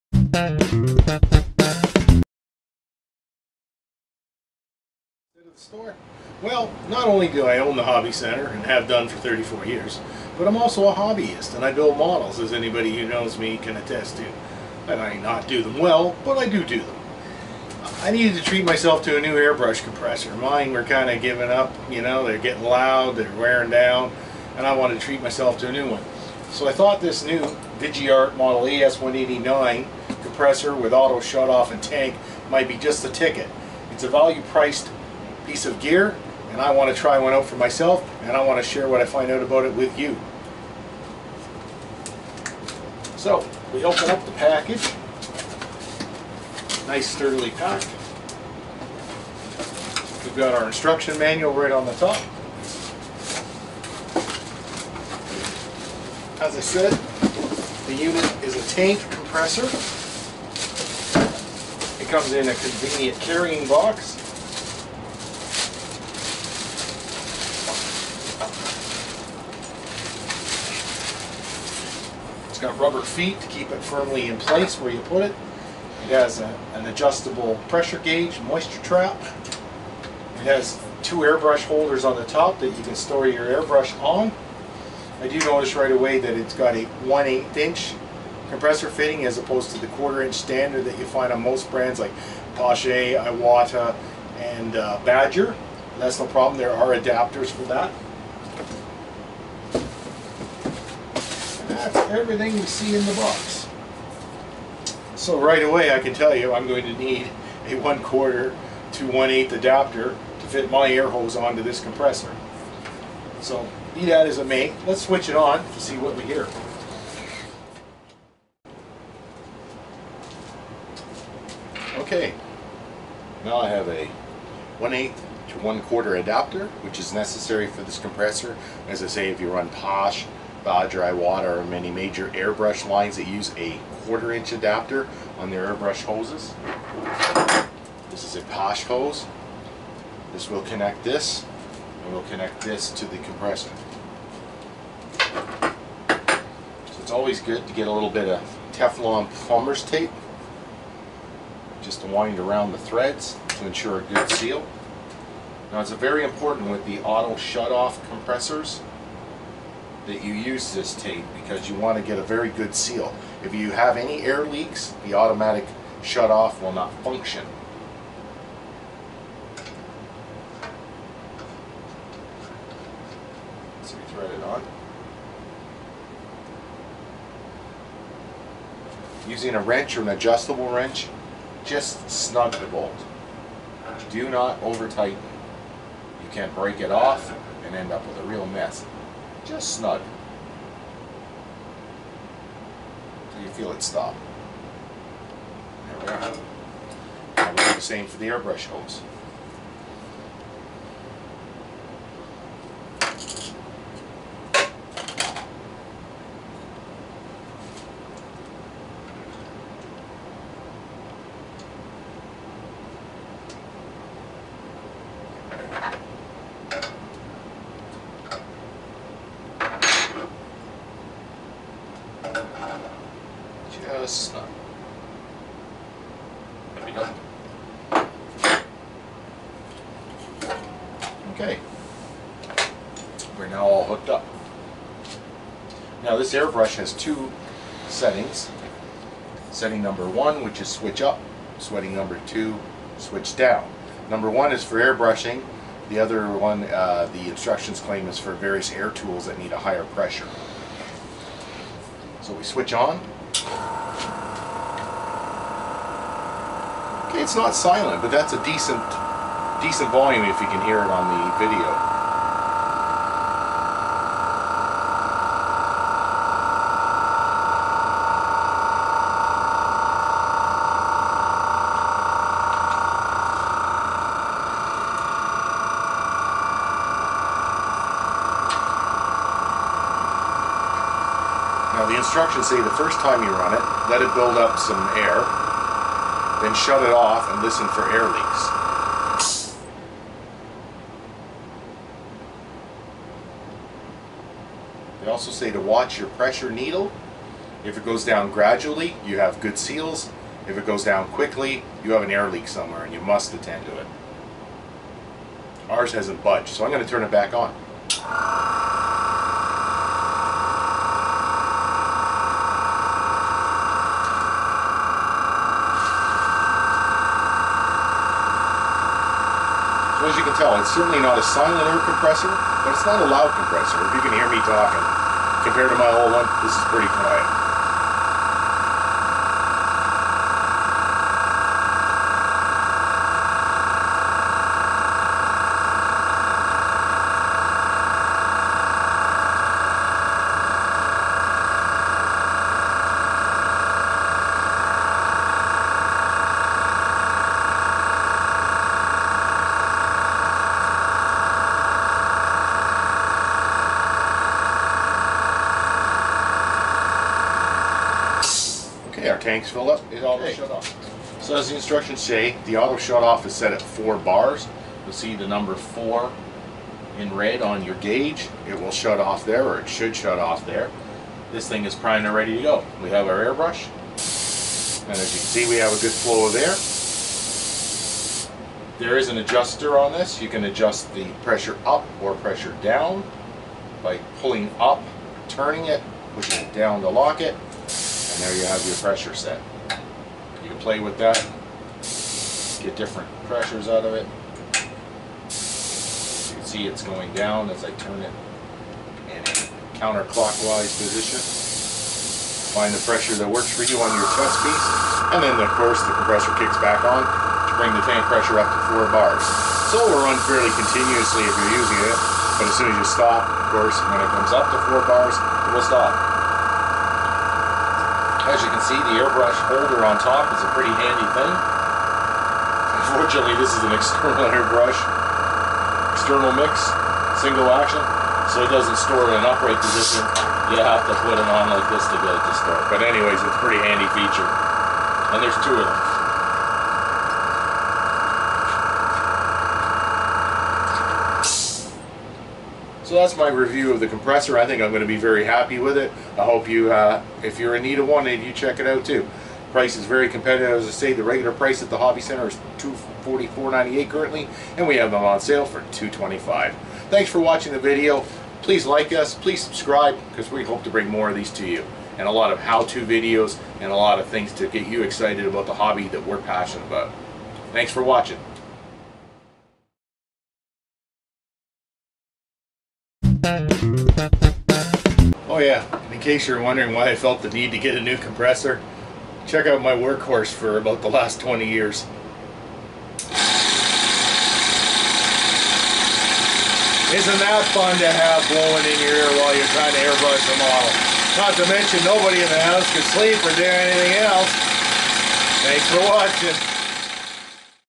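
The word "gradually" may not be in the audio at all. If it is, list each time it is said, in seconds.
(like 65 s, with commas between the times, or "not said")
298 s.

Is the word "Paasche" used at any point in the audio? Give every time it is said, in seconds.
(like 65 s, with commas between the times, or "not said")
92 s, 129 s, 138 s.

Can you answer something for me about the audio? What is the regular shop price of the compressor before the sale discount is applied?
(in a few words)
$244.98.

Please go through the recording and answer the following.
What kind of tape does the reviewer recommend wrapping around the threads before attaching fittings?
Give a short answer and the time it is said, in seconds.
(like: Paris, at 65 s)
Teflon plumber's tape, at 148 s.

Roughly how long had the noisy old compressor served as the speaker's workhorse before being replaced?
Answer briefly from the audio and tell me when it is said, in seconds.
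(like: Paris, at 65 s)
20 years, at 480 s.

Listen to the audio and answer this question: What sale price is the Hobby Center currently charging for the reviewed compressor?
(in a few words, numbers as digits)
$225.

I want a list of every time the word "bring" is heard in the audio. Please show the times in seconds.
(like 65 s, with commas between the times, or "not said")
407 s, 460 s.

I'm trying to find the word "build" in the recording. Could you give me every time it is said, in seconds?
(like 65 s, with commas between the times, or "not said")
11 s, 284 s.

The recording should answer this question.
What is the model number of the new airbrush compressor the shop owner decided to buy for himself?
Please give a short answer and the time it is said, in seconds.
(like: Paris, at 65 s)
ES189, at 28 s.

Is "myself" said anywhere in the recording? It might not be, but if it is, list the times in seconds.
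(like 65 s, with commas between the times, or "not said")
18 s, 25 s, 37 s.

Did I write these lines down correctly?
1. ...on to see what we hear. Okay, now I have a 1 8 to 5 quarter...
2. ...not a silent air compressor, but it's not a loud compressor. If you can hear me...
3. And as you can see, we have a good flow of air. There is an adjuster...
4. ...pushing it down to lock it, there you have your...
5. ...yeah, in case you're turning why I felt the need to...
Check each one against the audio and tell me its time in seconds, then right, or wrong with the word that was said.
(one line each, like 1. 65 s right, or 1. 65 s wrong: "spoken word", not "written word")
1. 115 s wrong: "1", not "5"
2. 320 s right
3. 374 s right
4. 386 s right
5. 475 s wrong: "wondering", not "turning".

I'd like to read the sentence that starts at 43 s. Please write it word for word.
So we open up the package, nice sturdily packed.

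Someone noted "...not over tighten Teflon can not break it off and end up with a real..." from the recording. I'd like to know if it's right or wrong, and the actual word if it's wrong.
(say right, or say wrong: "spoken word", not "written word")
wrong: "You", not "Teflon".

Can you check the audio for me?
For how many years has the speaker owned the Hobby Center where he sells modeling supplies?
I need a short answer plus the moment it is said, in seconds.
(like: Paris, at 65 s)
34, at 9 s.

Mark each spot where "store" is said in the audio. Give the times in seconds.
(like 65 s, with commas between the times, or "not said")
5 s, 82 s, 428 s.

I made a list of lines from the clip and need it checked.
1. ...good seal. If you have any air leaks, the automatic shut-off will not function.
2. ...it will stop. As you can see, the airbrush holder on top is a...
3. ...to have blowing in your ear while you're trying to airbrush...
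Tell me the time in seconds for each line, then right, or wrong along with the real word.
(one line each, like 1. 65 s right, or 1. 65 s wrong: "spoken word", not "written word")
1. 162 s right
2. 415 s right
3. 487 s right.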